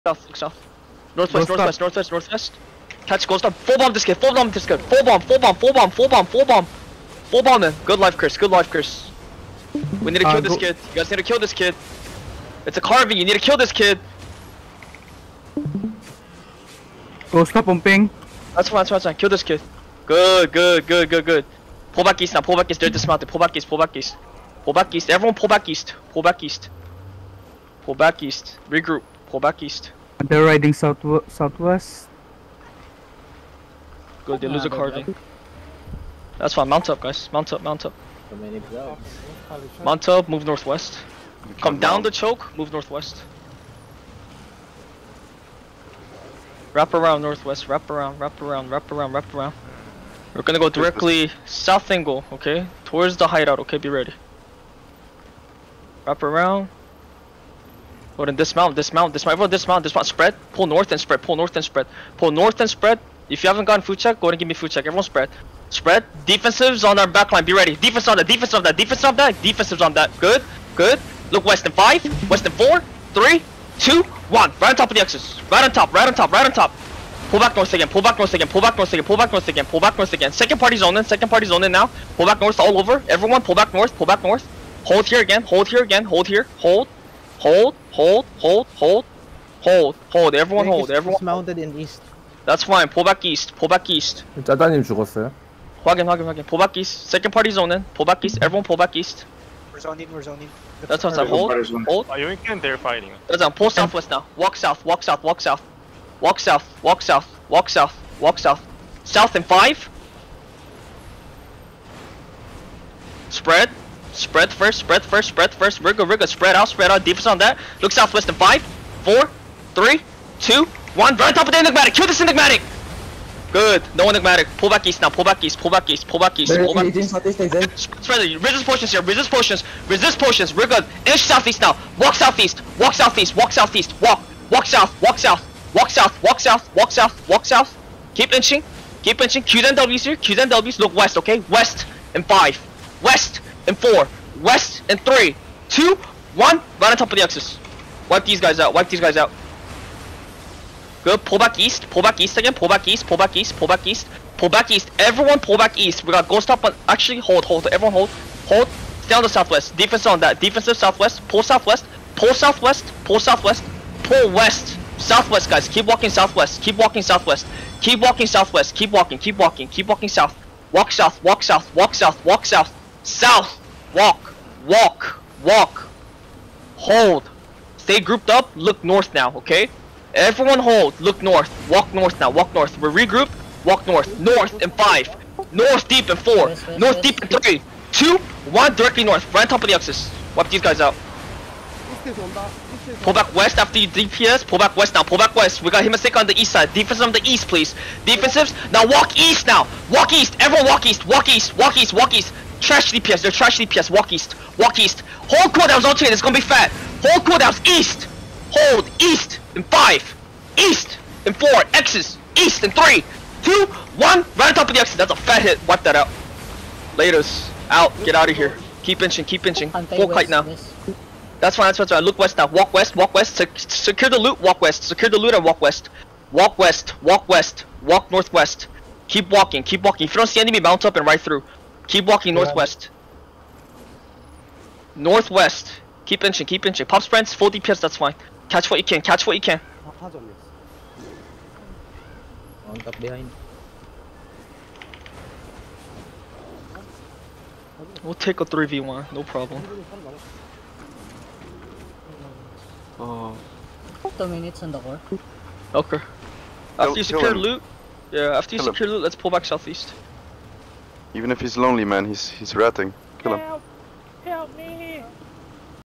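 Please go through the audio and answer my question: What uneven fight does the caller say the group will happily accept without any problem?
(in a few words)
3v1.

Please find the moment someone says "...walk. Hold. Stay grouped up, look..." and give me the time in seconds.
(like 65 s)
175 s.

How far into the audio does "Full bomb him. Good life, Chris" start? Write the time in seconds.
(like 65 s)
7 s.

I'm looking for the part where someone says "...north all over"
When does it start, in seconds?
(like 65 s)
82 s.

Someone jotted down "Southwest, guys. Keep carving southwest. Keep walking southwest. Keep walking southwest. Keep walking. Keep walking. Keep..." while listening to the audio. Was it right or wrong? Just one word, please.
wrong.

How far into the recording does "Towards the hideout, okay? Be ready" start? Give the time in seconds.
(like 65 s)
52 s.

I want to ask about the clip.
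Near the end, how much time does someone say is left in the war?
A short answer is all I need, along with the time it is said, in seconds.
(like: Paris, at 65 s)
Two minutes, at 254 s.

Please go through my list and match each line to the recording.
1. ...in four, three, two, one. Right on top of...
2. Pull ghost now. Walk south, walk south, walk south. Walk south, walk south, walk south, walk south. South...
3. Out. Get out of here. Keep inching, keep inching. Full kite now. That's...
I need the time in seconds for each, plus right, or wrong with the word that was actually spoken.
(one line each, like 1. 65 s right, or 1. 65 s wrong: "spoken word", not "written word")
1. 72 s right
2. 103 s wrong: "southwest", not "ghost"
3. 217 s right.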